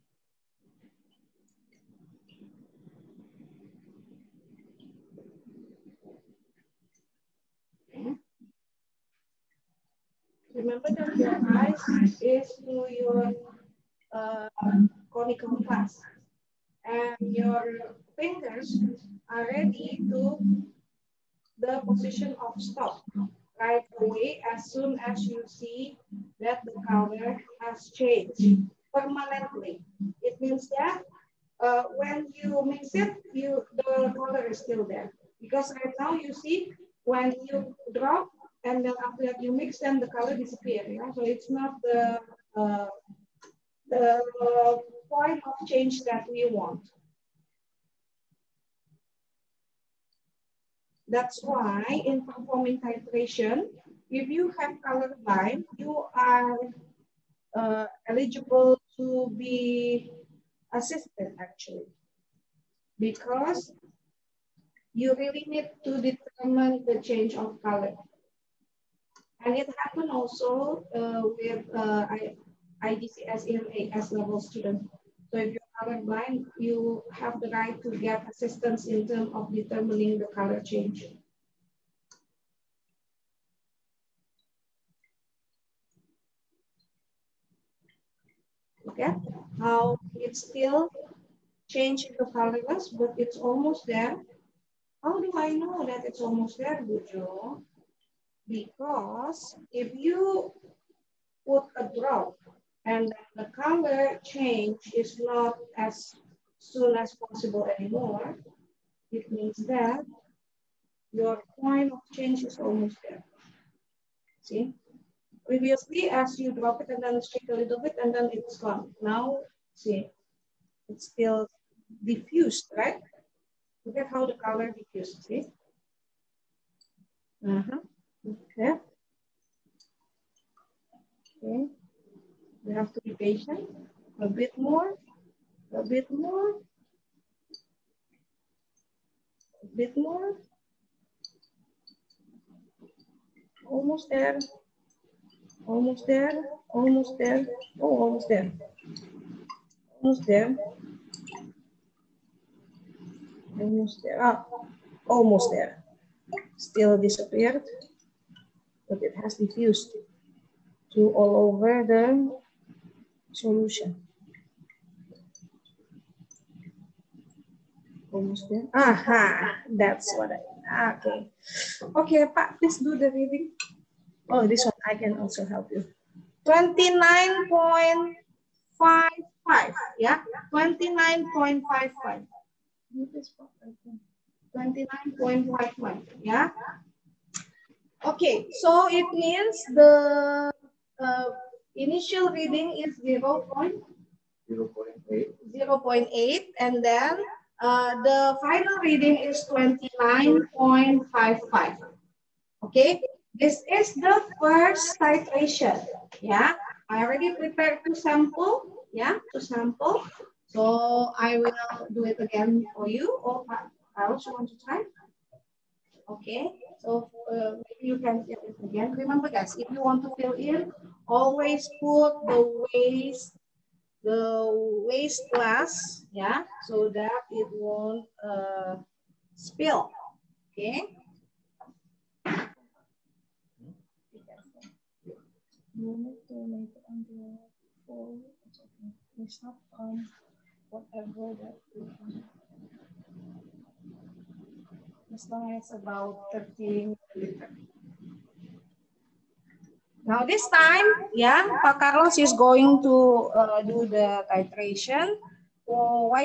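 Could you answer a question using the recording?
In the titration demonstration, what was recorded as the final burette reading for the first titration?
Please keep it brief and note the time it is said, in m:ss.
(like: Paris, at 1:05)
29.55, at 3:18.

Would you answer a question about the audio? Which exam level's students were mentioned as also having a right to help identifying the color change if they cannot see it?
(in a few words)
AS level.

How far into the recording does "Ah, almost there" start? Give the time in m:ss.
2:34.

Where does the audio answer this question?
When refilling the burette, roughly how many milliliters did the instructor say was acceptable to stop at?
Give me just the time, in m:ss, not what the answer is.
4:06.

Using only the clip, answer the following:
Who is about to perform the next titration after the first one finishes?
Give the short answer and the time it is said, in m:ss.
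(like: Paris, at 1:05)
Pak Carlos, at 4:11.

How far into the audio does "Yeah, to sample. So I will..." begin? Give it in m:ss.
3:28.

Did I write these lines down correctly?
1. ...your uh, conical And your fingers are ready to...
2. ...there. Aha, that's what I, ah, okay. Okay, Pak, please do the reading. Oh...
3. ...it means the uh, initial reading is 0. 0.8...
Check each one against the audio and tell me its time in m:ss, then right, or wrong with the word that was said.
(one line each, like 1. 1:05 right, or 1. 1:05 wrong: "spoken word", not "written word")
1. 0:12 right
2. 2:48 right
3. 3:08 right.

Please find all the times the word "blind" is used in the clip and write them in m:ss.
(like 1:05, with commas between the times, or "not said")
0:55, 1:16.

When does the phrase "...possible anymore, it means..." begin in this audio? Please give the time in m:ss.
1:47.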